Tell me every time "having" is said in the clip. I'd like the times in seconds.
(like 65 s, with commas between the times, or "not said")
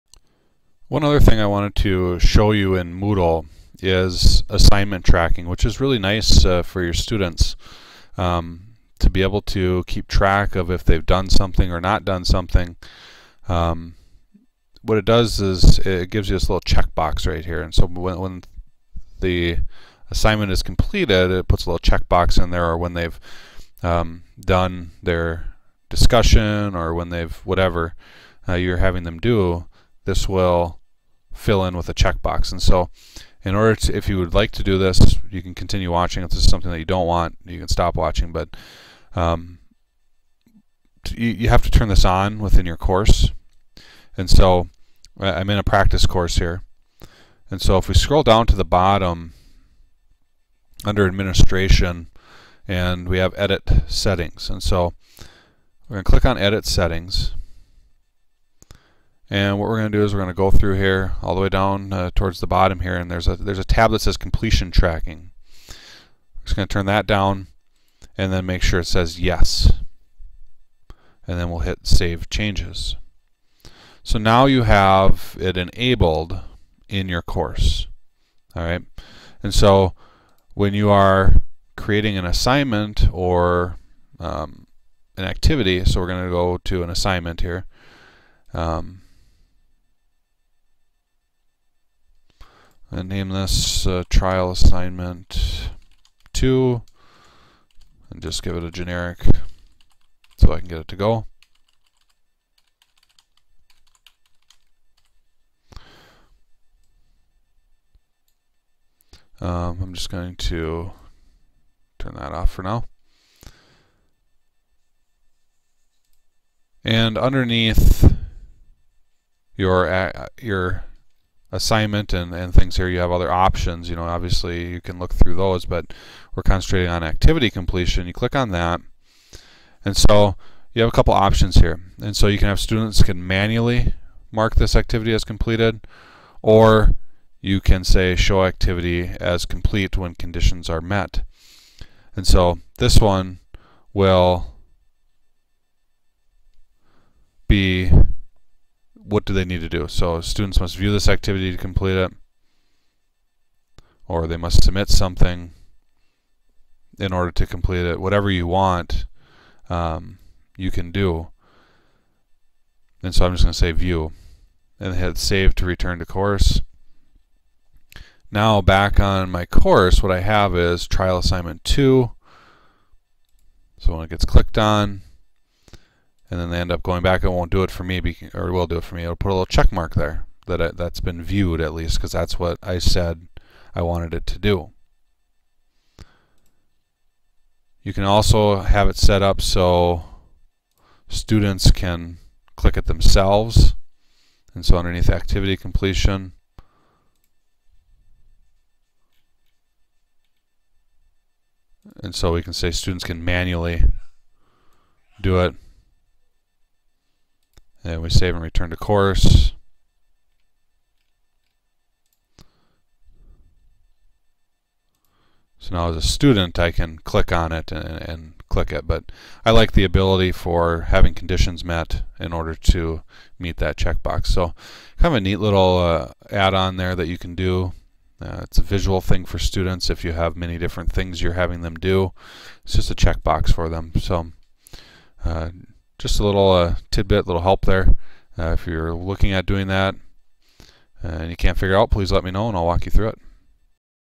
28 s, 220 s, 231 s.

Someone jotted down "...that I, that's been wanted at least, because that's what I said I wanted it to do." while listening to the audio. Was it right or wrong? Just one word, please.
wrong.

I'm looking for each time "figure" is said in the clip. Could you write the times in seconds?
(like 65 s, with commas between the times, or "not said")
241 s.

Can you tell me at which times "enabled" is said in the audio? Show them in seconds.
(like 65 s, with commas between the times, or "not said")
75 s.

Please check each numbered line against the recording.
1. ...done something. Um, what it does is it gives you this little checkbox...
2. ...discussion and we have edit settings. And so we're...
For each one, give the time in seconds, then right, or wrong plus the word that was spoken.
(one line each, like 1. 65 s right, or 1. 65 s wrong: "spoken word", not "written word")
1. 12 s right
2. 51 s wrong: "administration", not "discussion".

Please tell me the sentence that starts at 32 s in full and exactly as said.
And so in order to, if you would like to do this, you can continue watching.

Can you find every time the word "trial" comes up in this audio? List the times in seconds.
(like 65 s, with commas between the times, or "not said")
94 s, 170 s.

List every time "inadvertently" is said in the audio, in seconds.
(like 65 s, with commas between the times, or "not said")
not said.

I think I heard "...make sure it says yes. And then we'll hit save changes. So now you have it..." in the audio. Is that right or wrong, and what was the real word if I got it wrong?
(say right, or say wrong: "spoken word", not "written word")
right.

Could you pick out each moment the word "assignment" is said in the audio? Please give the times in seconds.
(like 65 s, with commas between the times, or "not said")
4 s, 20 s, 82 s, 86 s, 94 s, 121 s, 171 s.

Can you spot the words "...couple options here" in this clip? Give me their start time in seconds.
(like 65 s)
130 s.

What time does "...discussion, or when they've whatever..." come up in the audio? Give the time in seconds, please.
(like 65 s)
25 s.